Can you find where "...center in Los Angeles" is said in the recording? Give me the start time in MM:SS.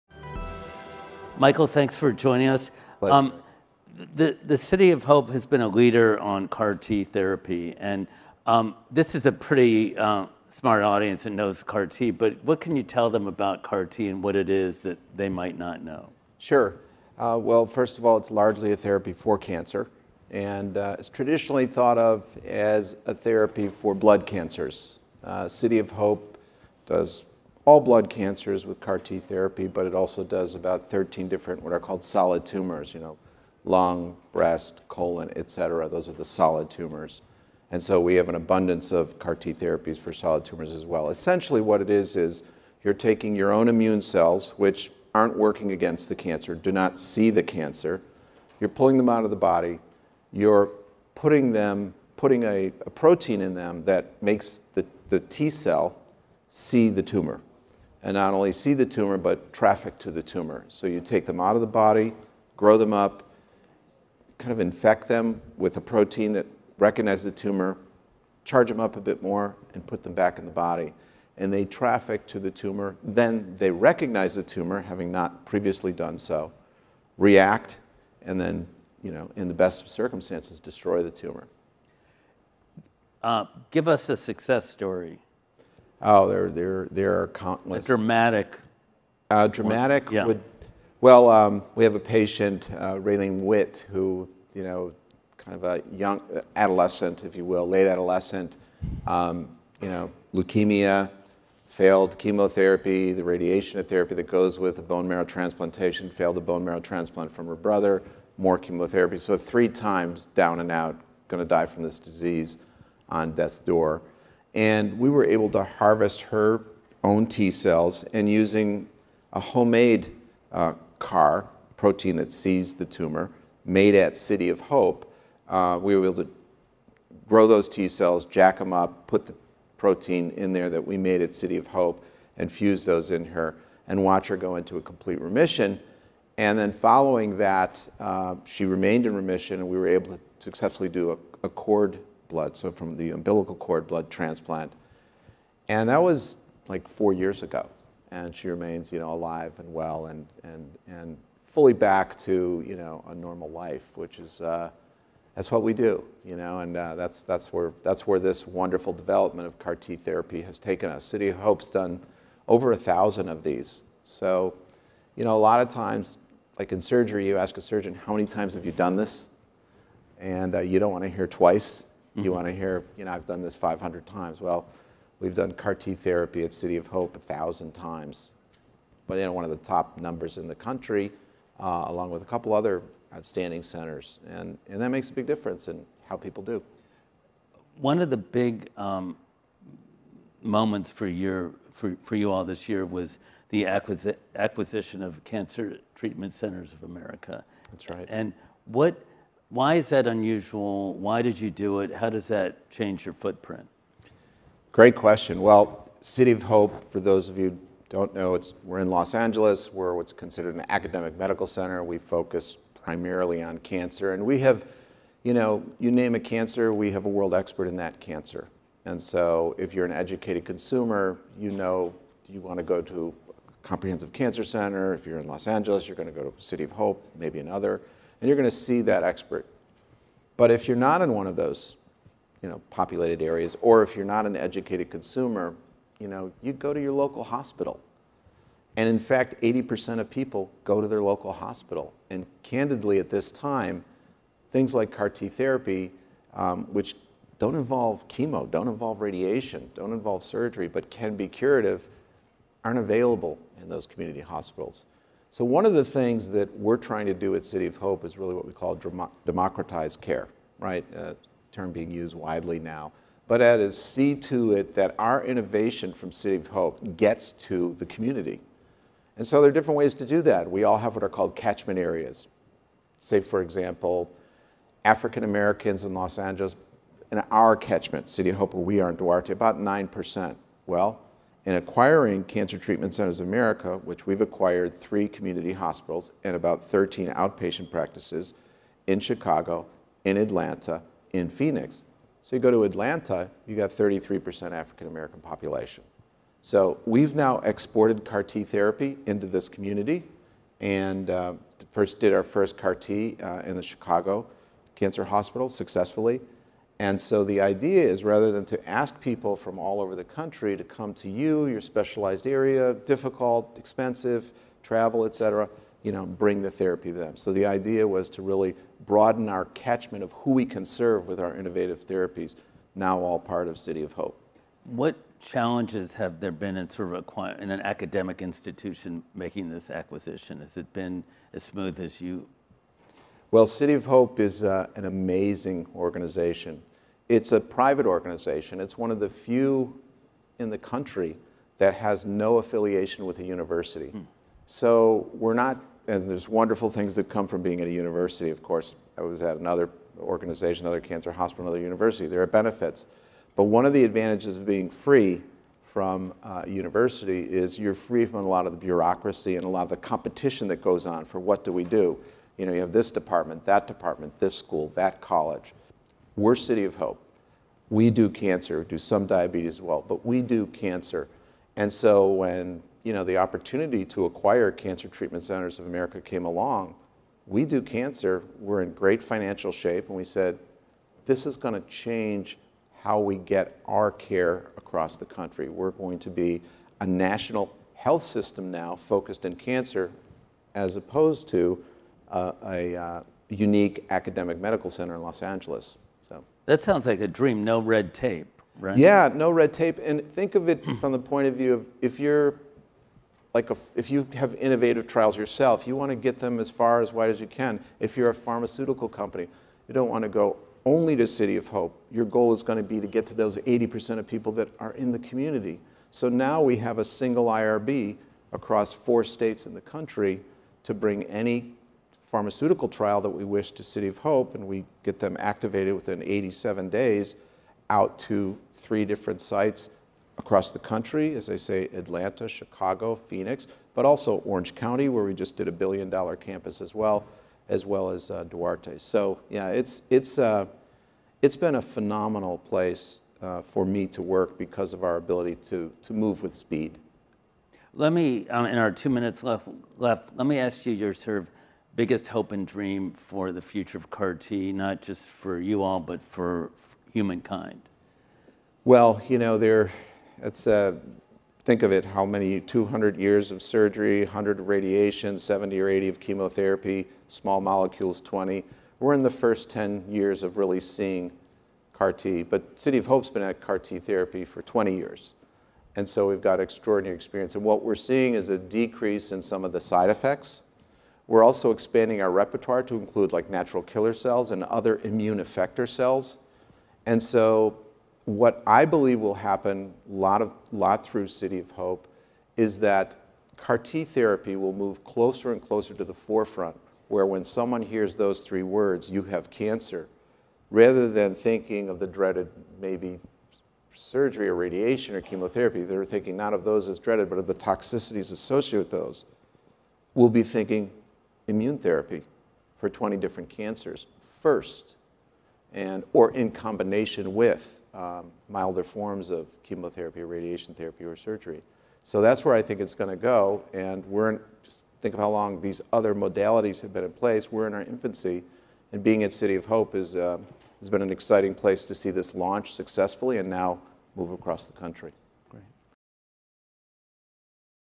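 06:34.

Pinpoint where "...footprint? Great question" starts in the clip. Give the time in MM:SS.
03:23.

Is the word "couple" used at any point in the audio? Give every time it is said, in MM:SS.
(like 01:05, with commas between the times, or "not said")
03:02.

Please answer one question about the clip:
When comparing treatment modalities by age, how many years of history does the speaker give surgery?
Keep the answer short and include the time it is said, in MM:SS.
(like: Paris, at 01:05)
200, at 07:42.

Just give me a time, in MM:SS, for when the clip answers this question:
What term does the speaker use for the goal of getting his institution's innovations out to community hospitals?
04:19.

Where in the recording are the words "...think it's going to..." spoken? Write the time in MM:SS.
08:42.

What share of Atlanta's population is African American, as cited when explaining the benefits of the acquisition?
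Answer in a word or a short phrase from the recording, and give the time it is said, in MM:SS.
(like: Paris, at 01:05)
33%, at 04:53.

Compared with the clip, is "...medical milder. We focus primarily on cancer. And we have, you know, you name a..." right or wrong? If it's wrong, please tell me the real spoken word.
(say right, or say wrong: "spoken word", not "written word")
wrong: "center", not "milder".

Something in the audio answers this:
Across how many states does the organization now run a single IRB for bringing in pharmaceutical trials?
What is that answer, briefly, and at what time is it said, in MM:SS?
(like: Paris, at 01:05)
4, at 06:58.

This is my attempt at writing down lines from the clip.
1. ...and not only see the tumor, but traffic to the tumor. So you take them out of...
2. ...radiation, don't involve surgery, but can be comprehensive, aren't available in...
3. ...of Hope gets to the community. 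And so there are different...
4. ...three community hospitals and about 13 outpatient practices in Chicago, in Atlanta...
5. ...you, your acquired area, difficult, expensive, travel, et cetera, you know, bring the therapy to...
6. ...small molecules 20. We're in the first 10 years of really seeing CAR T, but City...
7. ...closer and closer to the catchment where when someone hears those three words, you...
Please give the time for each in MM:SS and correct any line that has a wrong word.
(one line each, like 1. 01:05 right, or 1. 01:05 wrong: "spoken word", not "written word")
1. 00:58 right
2. 04:09 wrong: "curative", not "comprehensive"
3. 04:26 right
4. 04:44 right
5. 05:11 wrong: "specialized", not "acquired"
6. 07:47 right
7. 08:14 wrong: "forefront", not "catchment".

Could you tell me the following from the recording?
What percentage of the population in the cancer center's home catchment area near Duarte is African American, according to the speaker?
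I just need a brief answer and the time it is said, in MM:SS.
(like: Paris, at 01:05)
9%, at 04:39.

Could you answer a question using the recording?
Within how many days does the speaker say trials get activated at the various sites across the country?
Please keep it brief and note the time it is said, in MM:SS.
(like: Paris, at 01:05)
87, at 07:06.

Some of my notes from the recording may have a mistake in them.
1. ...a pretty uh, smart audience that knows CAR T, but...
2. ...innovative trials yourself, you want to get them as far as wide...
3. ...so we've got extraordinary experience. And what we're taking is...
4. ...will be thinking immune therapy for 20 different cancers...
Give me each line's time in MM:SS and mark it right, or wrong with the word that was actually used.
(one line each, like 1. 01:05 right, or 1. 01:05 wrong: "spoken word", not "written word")
1. 00:09 right
2. 06:44 right
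3. 07:55 wrong: "seeing", not "taking"
4. 08:29 right.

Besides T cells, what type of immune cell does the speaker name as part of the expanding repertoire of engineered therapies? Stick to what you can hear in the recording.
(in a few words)
natural killer cells.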